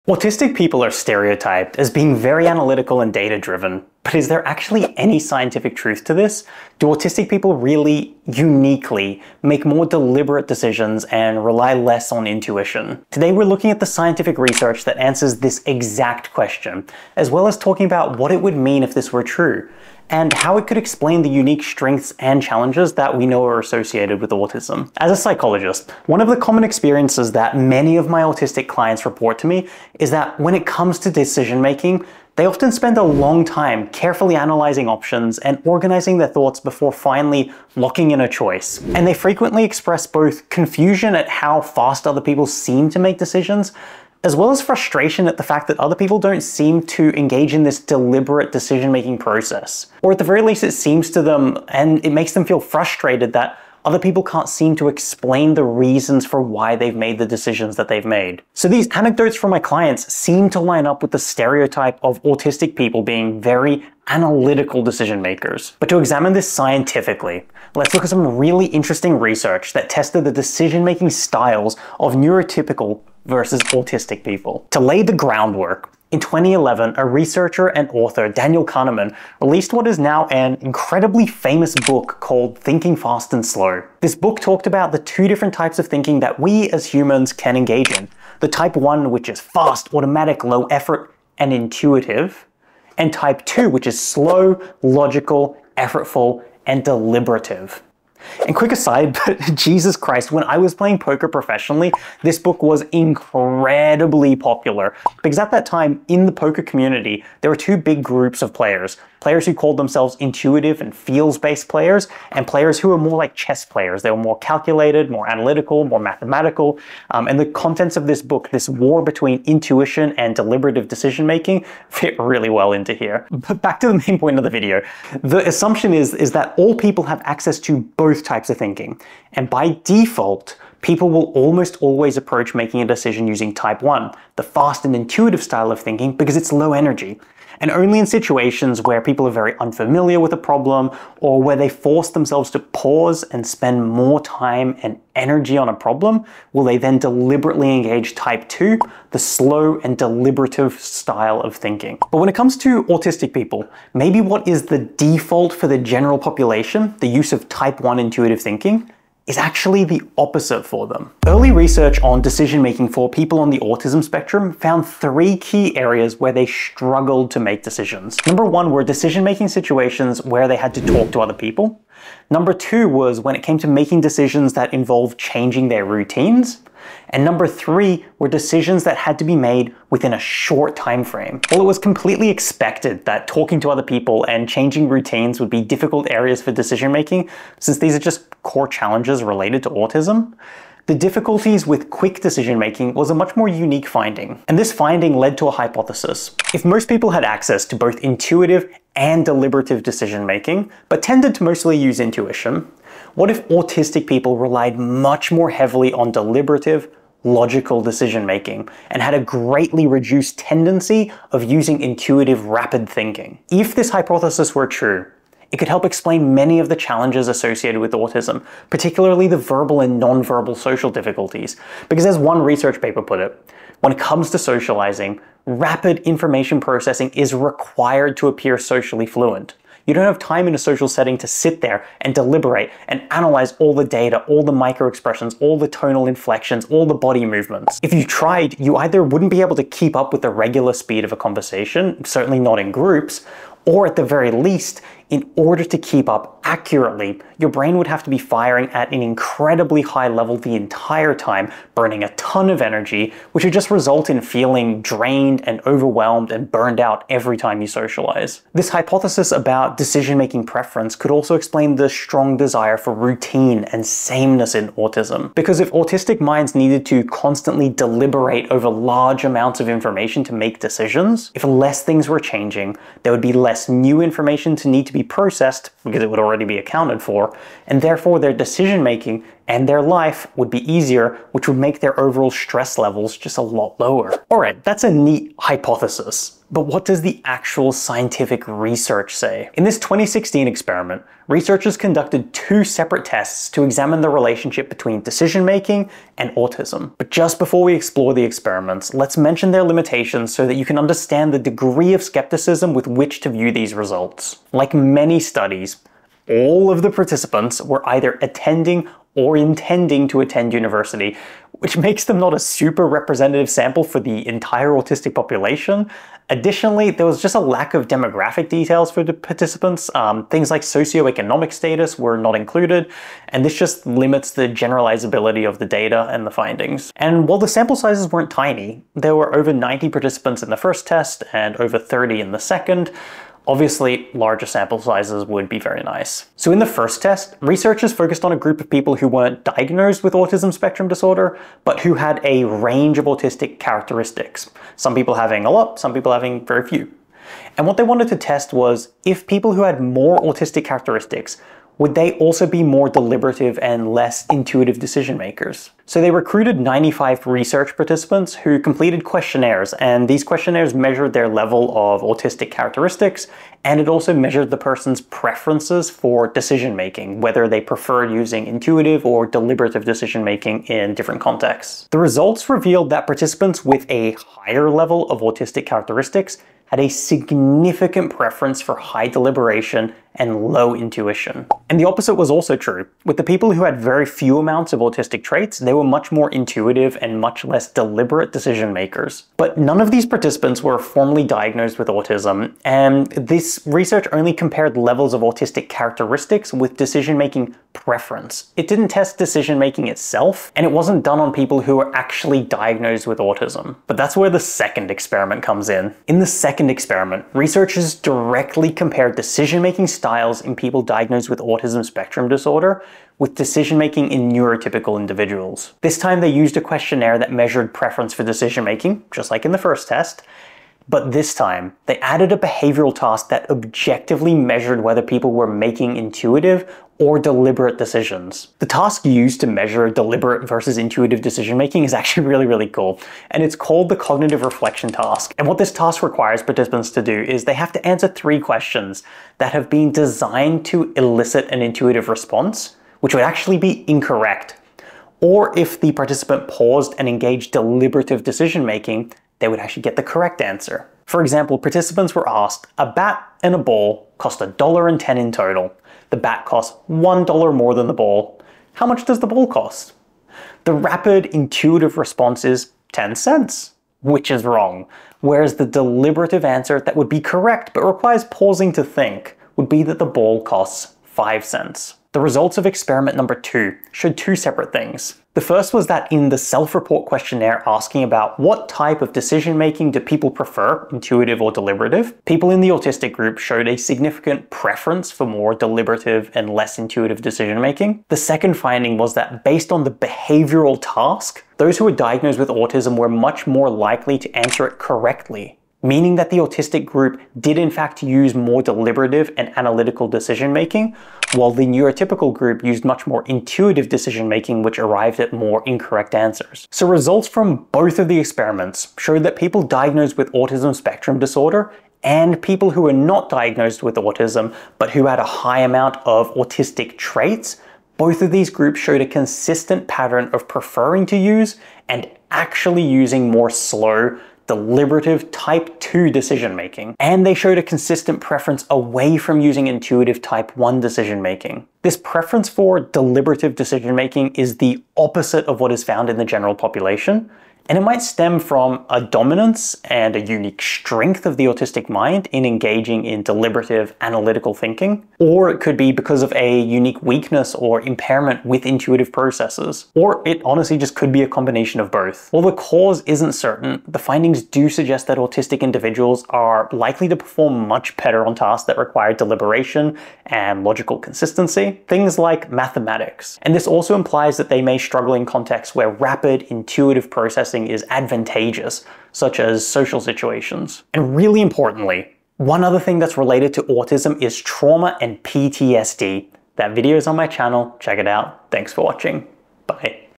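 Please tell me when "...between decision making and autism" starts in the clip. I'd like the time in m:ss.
4:54.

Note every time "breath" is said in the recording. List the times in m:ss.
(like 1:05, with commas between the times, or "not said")
not said.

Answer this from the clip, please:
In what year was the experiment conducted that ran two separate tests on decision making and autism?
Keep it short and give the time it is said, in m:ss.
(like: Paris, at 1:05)
2016, at 4:49.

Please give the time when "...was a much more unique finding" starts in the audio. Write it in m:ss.
3:12.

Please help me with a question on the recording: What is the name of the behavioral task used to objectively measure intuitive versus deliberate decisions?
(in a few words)
cognitive reflection task.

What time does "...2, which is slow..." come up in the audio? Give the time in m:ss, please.
1:33.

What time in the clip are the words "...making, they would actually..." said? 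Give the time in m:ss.
7:28.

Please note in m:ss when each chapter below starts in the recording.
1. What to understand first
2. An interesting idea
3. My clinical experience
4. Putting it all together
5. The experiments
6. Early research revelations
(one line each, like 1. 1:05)
1. 1:14
2. 3:14
3. 0:24
4. 8:26
5. 4:44
6. 2:41.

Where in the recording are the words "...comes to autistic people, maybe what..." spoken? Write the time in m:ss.
2:32.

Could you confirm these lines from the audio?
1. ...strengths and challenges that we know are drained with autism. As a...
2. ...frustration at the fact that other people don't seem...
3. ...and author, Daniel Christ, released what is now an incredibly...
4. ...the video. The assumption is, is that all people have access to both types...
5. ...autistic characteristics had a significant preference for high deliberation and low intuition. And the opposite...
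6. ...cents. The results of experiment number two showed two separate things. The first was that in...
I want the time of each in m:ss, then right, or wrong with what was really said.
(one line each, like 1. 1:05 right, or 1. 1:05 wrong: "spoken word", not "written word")
1. 0:21 wrong: "associated", not "drained"
2. 0:44 right
3. 1:17 wrong: "Kahneman", not "Christ"
4. 2:04 right
5. 6:15 right
6. 7:51 right.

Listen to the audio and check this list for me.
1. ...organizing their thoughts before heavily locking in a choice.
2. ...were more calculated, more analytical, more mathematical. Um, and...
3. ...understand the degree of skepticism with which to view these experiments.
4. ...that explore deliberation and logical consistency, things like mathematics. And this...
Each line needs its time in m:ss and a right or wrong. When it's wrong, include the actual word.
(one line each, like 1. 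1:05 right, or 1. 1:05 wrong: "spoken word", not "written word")
1. 0:35 wrong: "finally", not "heavily"
2. 1:54 right
3. 5:00 wrong: "results", not "experiments"
4. 9:18 wrong: "require", not "explore".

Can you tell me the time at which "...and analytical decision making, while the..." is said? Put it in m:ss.
8:19.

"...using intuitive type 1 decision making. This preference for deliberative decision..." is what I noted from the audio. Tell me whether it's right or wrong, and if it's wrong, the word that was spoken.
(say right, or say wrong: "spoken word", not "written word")
right.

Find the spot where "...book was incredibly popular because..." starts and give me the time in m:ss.
1:42.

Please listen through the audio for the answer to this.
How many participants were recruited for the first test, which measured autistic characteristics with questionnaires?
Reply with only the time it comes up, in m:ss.
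5:56.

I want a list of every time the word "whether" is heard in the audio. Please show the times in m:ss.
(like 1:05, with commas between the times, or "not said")
6:07, 7:04.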